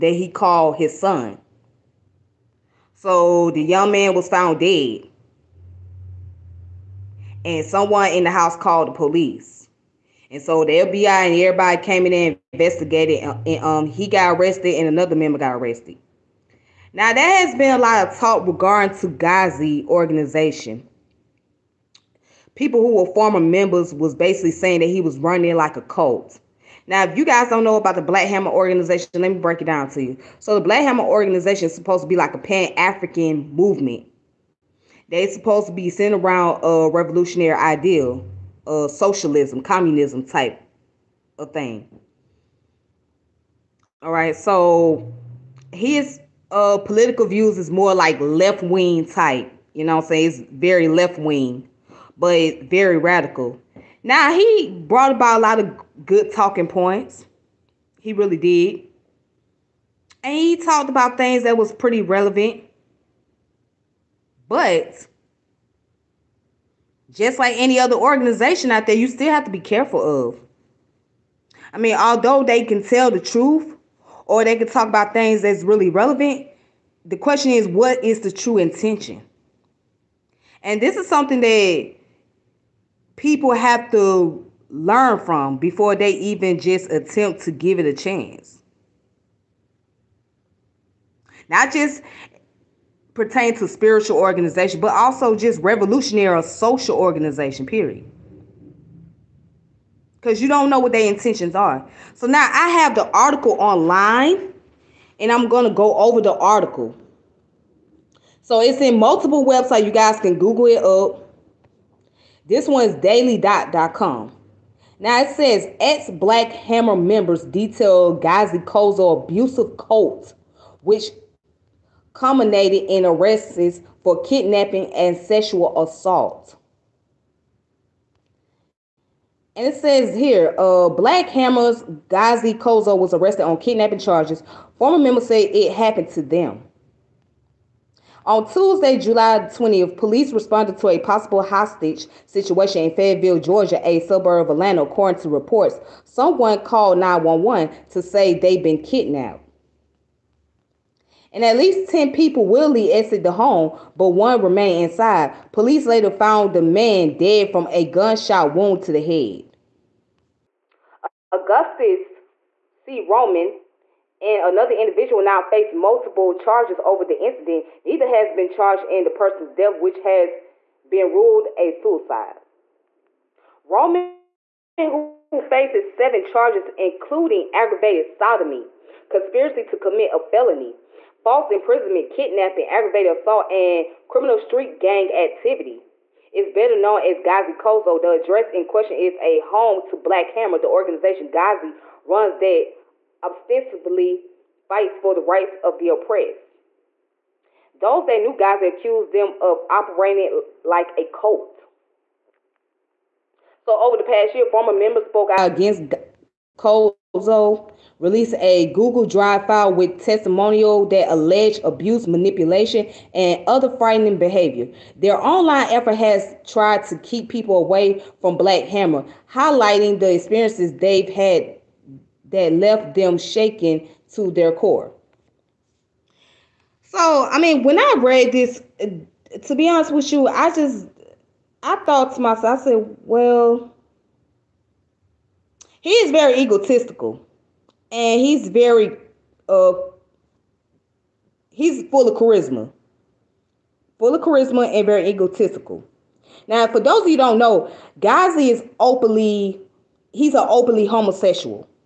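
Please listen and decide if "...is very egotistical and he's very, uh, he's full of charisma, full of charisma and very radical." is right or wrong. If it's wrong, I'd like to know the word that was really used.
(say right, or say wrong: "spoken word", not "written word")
wrong: "egotistical", not "radical".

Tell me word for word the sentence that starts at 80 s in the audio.
And this is something that people have to learn from before they even just attempt to give it a chance.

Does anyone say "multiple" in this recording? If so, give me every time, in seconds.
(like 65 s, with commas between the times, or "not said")
108 s, 165 s.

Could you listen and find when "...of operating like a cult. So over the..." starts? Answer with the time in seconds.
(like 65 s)
199 s.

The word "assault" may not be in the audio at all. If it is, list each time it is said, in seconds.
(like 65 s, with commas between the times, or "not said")
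125 s, 183 s.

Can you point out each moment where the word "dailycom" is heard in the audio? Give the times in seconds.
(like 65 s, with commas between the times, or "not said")
112 s.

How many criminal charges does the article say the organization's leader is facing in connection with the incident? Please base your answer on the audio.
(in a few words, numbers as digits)
7.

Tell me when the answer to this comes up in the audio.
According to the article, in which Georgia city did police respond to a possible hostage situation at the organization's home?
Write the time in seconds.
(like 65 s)
142 s.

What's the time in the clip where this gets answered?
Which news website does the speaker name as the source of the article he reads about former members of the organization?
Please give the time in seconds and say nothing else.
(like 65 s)
112 s.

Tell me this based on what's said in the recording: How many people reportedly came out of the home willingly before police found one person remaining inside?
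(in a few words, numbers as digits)
10.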